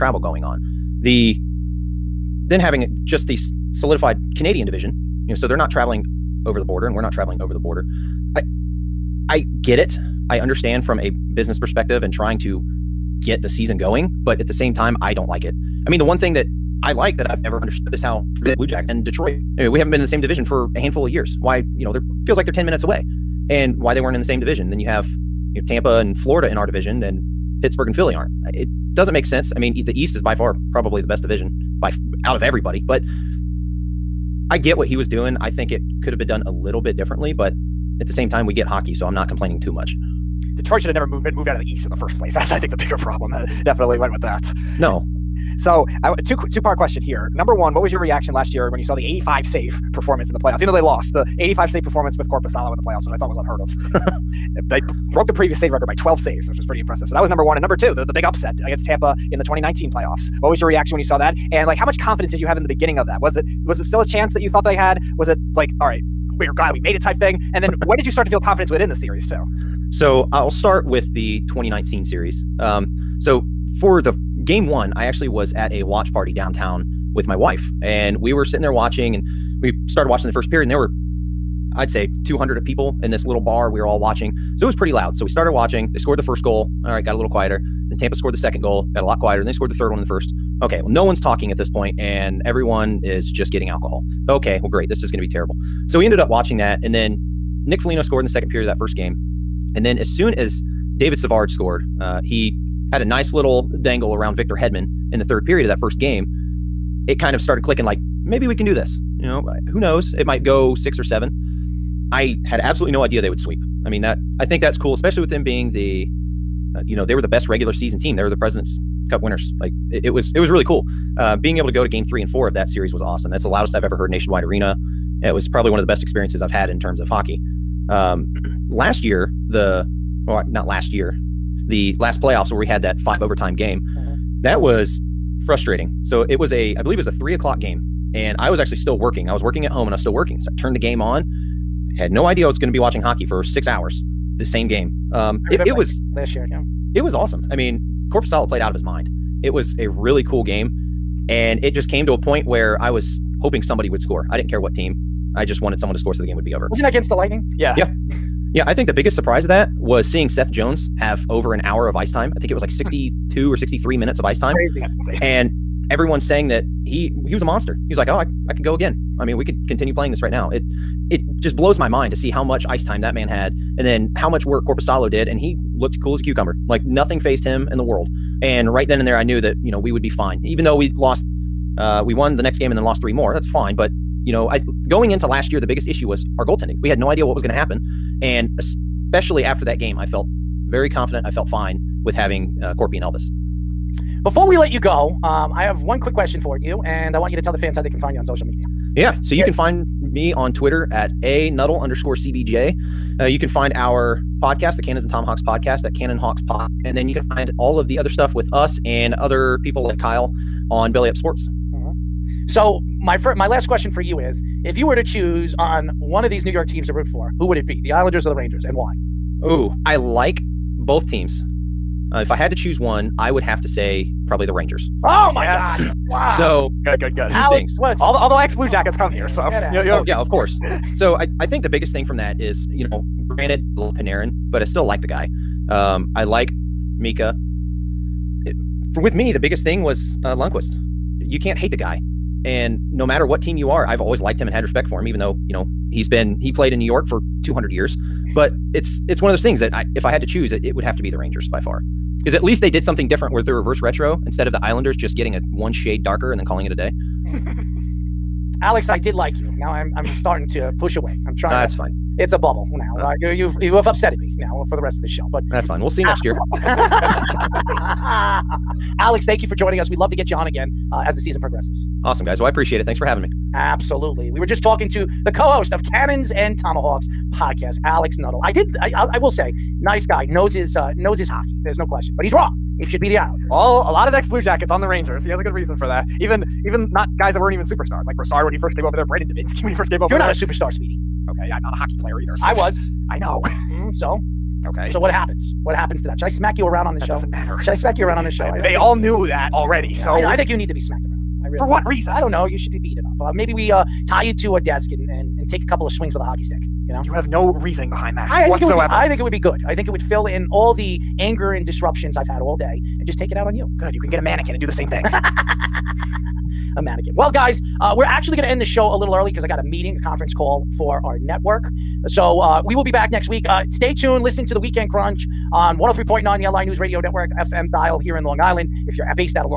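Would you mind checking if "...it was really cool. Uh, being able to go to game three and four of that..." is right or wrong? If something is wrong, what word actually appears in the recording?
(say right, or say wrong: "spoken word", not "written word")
right.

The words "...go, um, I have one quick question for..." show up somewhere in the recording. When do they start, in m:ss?
3:14.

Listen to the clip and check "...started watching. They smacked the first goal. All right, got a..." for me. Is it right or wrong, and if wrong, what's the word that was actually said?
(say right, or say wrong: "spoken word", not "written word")
wrong: "scored", not "smacked".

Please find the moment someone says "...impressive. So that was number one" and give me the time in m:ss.
0:56.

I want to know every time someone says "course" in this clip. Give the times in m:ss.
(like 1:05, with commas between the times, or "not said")
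3:50.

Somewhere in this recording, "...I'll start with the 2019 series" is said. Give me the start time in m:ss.
1:10.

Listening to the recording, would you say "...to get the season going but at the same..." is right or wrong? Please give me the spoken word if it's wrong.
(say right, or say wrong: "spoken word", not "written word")
right.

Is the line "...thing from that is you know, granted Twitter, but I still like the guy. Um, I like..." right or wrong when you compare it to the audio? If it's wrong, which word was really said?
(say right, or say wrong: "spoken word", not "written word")
wrong: "Panarin", not "Twitter".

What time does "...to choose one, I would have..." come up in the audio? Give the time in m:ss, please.
3:42.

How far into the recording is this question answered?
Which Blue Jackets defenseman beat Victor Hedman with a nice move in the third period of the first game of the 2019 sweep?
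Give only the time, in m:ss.
1:40.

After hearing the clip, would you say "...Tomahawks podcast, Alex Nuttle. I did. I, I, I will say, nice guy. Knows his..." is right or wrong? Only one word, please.
right.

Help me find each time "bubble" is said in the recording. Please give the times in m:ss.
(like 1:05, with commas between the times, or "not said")
4:22.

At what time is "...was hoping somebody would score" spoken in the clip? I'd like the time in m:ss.
2:32.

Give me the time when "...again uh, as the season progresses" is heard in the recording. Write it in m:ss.
4:30.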